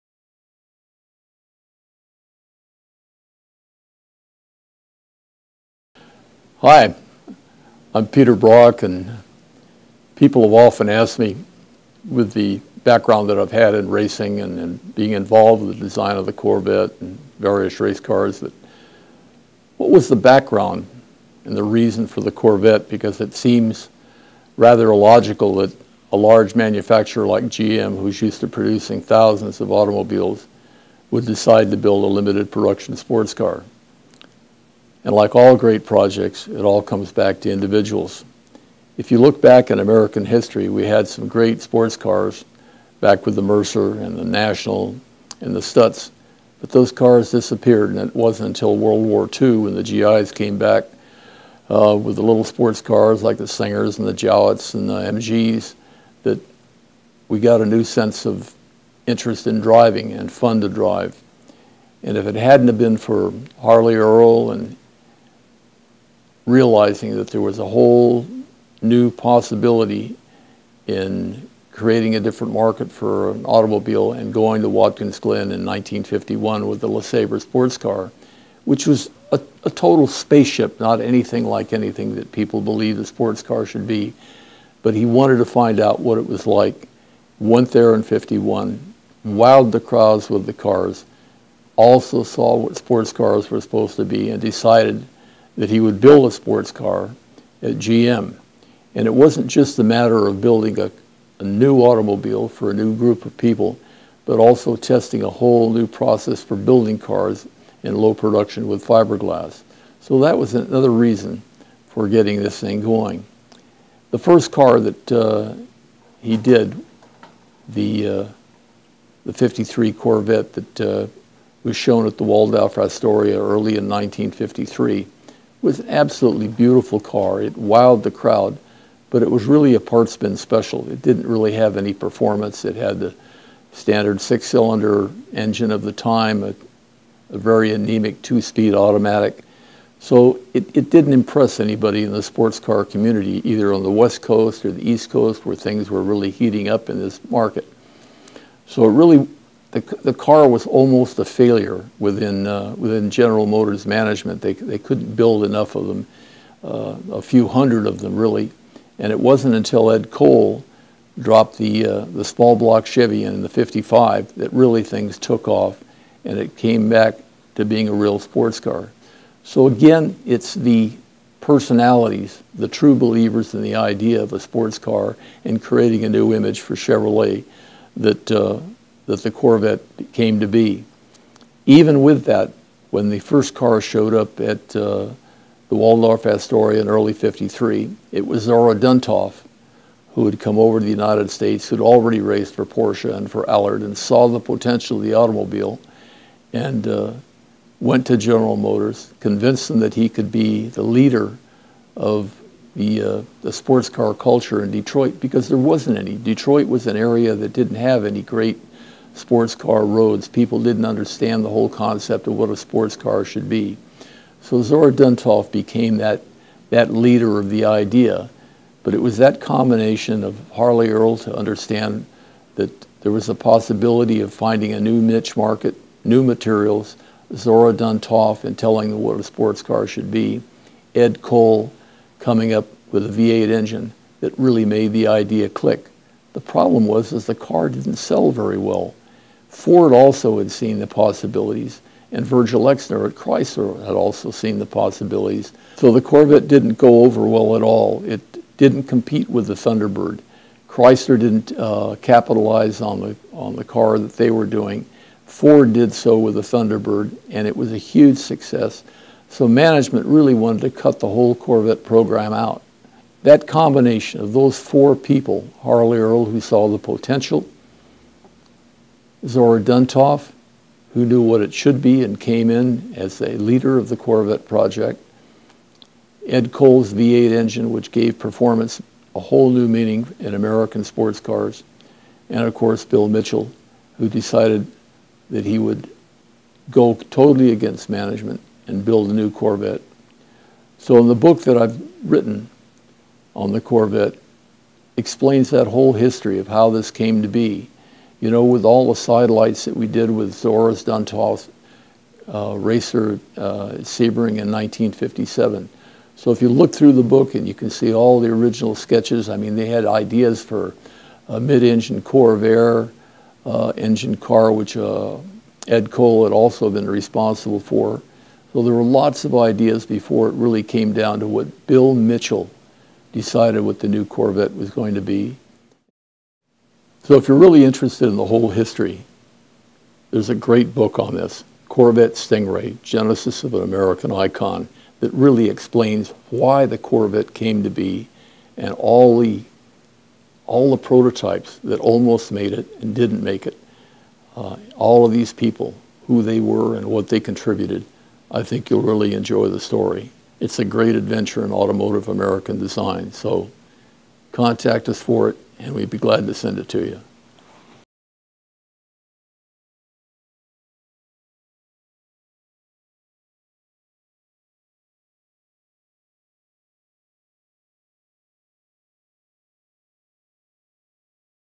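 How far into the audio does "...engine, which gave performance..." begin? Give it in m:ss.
4:37.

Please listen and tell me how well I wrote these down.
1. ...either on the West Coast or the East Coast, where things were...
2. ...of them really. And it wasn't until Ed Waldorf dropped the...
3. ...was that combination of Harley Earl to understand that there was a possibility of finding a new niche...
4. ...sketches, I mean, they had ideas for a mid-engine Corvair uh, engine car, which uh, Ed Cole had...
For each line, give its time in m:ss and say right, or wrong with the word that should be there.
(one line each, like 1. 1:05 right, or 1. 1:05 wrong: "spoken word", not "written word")
1. 2:23 right
2. 2:37 wrong: "Cole", not "Waldorf"
3. 3:39 right
4. 5:08 right.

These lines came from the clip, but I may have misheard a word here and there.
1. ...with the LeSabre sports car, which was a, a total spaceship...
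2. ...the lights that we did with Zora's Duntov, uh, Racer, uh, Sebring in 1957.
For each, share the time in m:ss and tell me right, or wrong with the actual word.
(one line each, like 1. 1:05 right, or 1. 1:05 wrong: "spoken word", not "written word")
1. 1:16 right
2. 4:58 right.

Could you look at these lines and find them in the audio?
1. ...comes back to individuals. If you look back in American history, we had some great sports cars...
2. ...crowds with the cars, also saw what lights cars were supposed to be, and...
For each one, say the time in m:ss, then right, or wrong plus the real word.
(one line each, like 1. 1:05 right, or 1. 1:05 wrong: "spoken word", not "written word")
1. 0:36 right
2. 1:29 wrong: "sports", not "lights".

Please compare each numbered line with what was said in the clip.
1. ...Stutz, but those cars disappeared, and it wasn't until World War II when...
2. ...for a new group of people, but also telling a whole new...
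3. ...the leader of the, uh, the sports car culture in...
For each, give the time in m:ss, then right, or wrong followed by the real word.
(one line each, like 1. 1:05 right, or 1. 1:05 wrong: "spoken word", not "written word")
1. 0:45 right
2. 1:42 wrong: "testing", not "telling"
3. 3:20 right.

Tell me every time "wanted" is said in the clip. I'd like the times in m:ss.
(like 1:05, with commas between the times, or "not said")
1:25, 4:20.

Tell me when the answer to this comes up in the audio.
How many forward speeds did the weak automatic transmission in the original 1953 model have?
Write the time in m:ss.
2:18.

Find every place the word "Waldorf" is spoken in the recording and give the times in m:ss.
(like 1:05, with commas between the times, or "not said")
2:02, 3:05.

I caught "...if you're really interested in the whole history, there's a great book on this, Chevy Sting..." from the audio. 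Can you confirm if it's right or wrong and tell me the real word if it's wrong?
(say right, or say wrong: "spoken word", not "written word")
wrong: "Corvette", not "Chevy".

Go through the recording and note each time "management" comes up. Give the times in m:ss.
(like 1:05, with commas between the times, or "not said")
2:33, 4:19, 4:47.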